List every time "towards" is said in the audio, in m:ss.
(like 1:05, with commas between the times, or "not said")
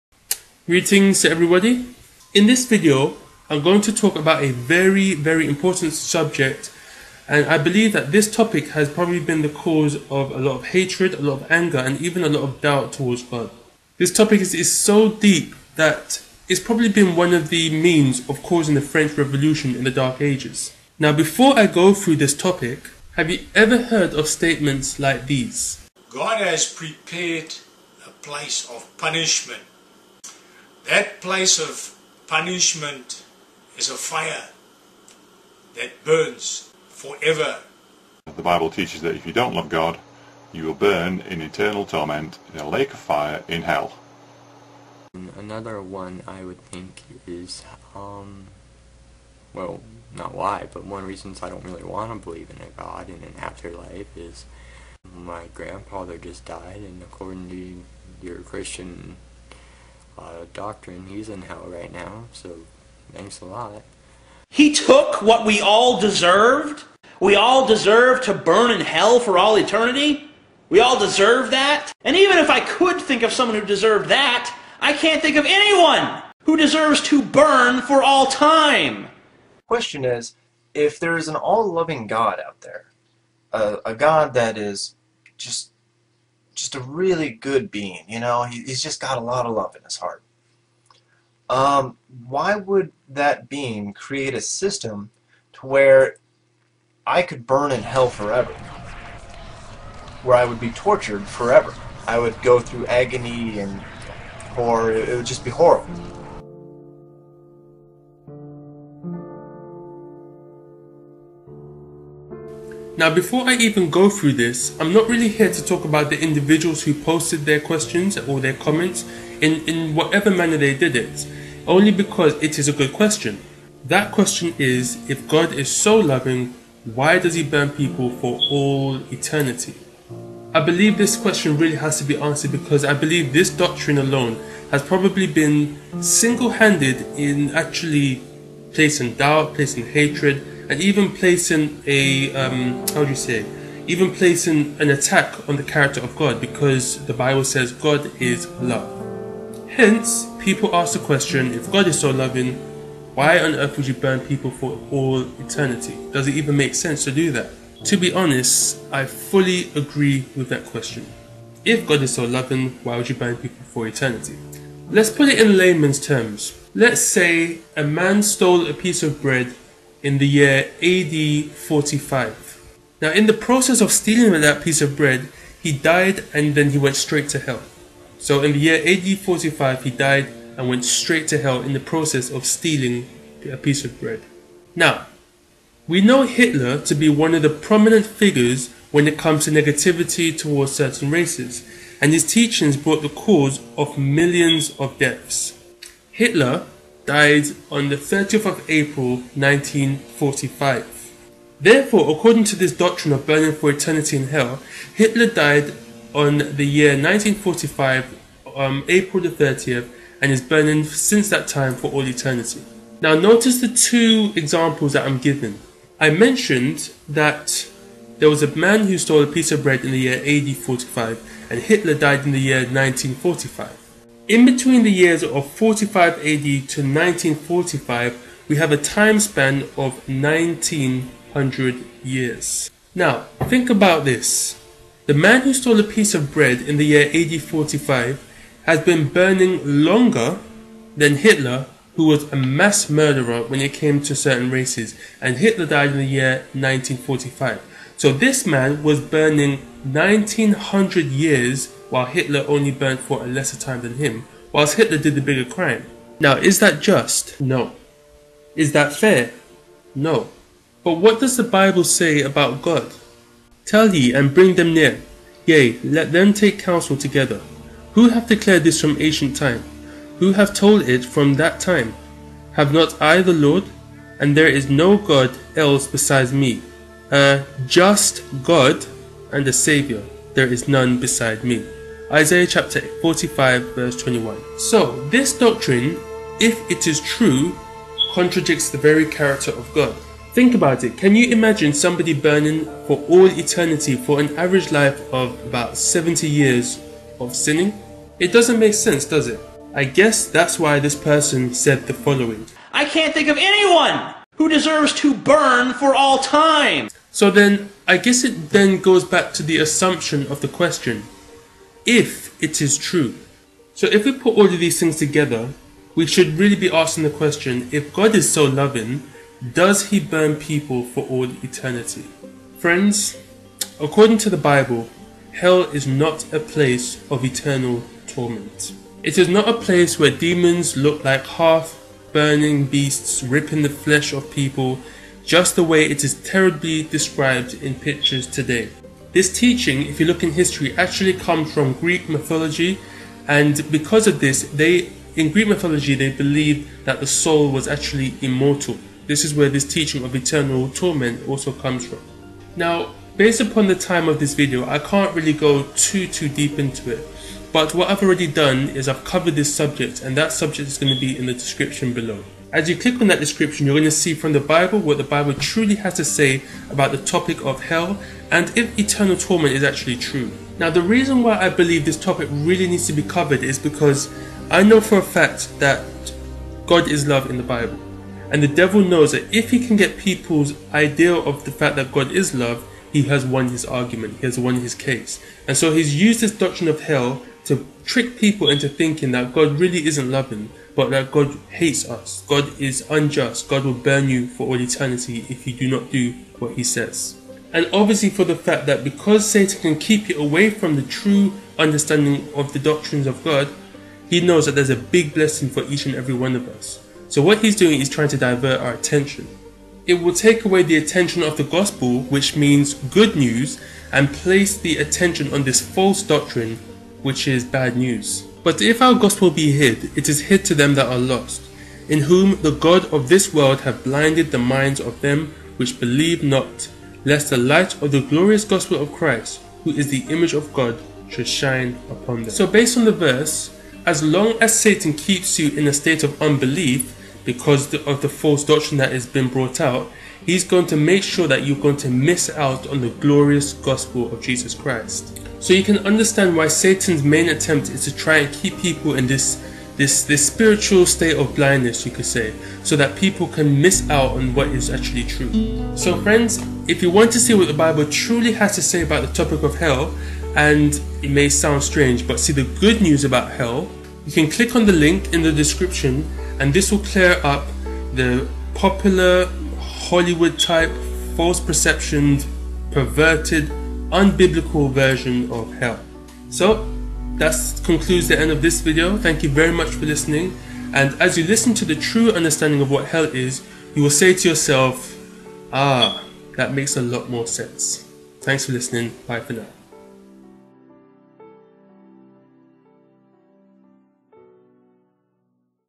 0:12, 3:10.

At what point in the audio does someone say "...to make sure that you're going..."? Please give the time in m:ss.
7:20.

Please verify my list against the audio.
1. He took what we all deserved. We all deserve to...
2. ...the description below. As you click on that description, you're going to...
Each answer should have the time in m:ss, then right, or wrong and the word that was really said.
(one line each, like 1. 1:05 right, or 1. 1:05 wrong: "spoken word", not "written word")
1. 1:04 right
2. 6:01 right.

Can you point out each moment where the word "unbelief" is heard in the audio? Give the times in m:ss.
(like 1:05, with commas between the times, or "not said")
7:16.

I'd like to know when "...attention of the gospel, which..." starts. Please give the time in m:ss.
6:50.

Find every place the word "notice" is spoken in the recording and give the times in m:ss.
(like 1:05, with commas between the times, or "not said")
3:33.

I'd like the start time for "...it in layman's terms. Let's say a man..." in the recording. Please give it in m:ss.
2:45.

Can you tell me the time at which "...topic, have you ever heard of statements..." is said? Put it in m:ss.
0:22.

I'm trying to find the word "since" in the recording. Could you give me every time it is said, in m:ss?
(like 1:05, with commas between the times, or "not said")
3:30.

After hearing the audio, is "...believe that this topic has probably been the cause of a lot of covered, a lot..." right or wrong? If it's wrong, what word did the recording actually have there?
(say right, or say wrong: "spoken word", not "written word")
wrong: "hatred", not "covered".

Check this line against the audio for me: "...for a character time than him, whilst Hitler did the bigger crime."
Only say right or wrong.
wrong.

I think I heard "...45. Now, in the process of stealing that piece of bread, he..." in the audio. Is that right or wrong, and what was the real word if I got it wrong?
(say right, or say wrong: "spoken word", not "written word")
right.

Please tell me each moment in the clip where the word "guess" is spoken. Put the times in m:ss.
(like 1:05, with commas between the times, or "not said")
4:59, 5:07.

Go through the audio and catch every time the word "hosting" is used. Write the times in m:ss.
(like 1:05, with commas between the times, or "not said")
not said.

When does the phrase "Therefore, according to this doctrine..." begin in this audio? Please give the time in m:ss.
3:21.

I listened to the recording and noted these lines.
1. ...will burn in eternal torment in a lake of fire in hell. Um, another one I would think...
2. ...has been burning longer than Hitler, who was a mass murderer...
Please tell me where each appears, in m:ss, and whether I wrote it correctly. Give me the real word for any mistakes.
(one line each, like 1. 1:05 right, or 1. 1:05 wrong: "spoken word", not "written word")
1. 0:40 right
2. 3:58 right.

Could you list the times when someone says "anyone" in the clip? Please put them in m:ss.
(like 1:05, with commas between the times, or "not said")
1:15, 5:03.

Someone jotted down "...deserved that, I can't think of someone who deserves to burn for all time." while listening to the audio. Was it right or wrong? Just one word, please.
wrong.